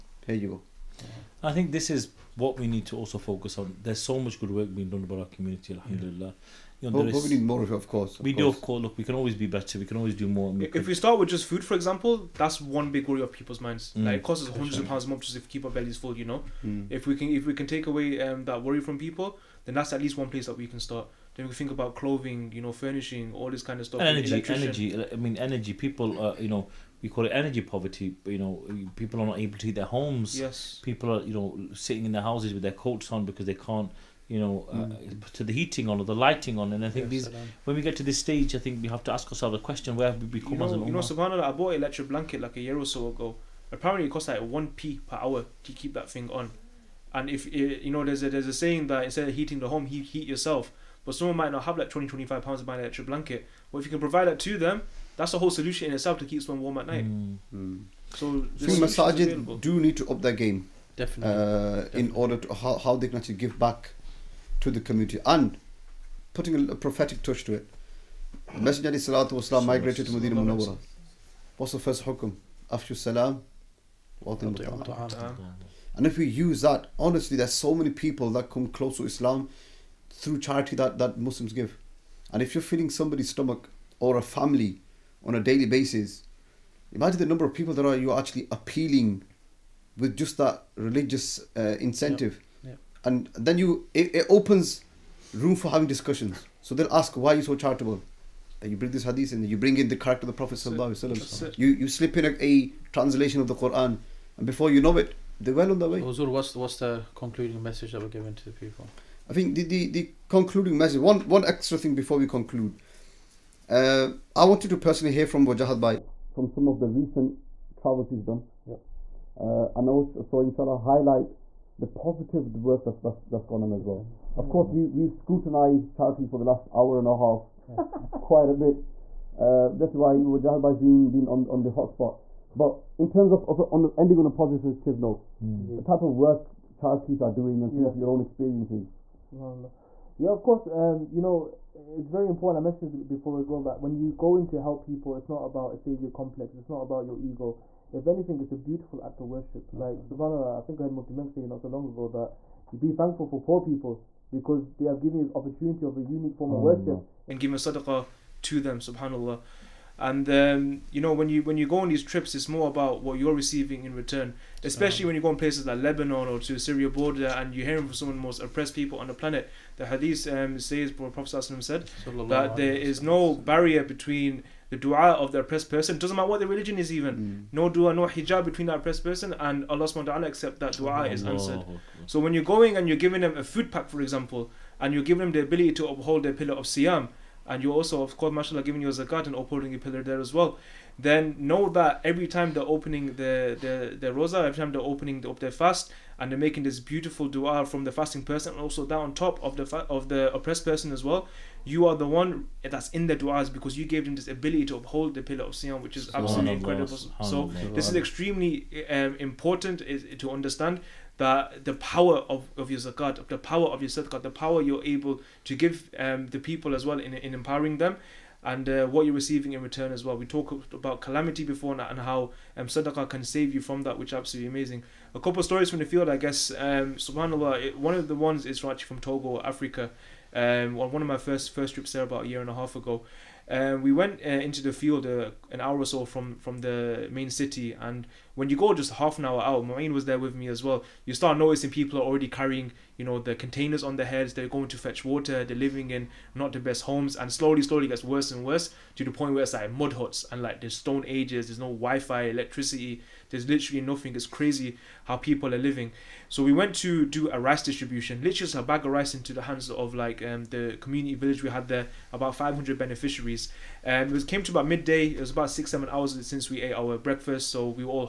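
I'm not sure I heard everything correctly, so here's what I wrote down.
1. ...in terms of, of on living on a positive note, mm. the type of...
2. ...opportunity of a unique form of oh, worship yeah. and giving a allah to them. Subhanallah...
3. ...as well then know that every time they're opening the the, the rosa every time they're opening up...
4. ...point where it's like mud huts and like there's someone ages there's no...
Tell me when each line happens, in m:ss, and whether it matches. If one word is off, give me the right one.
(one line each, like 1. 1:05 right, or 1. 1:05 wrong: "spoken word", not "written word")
1. 2:12 wrong: "ending", not "living"
2. 2:35 wrong: "sadaqah", not "allah"
3. 3:10 right
4. 4:09 wrong: "stone", not "someone".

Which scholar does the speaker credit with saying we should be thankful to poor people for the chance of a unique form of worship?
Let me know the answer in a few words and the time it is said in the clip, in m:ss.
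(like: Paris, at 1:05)
Mufti Menk, at 2:30.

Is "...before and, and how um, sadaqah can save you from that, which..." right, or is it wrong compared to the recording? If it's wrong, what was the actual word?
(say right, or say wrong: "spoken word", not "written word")
right.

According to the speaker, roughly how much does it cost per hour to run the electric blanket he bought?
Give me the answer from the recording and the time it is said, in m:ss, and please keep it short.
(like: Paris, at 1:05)
1p, at 0:44.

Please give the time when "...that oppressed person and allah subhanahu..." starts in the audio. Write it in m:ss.
2:58.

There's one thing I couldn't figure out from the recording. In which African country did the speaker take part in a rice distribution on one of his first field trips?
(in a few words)
Togo.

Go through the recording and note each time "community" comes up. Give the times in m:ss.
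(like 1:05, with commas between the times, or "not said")
0:05, 1:04, 4:20.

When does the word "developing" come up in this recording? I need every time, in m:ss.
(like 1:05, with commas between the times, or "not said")
not said.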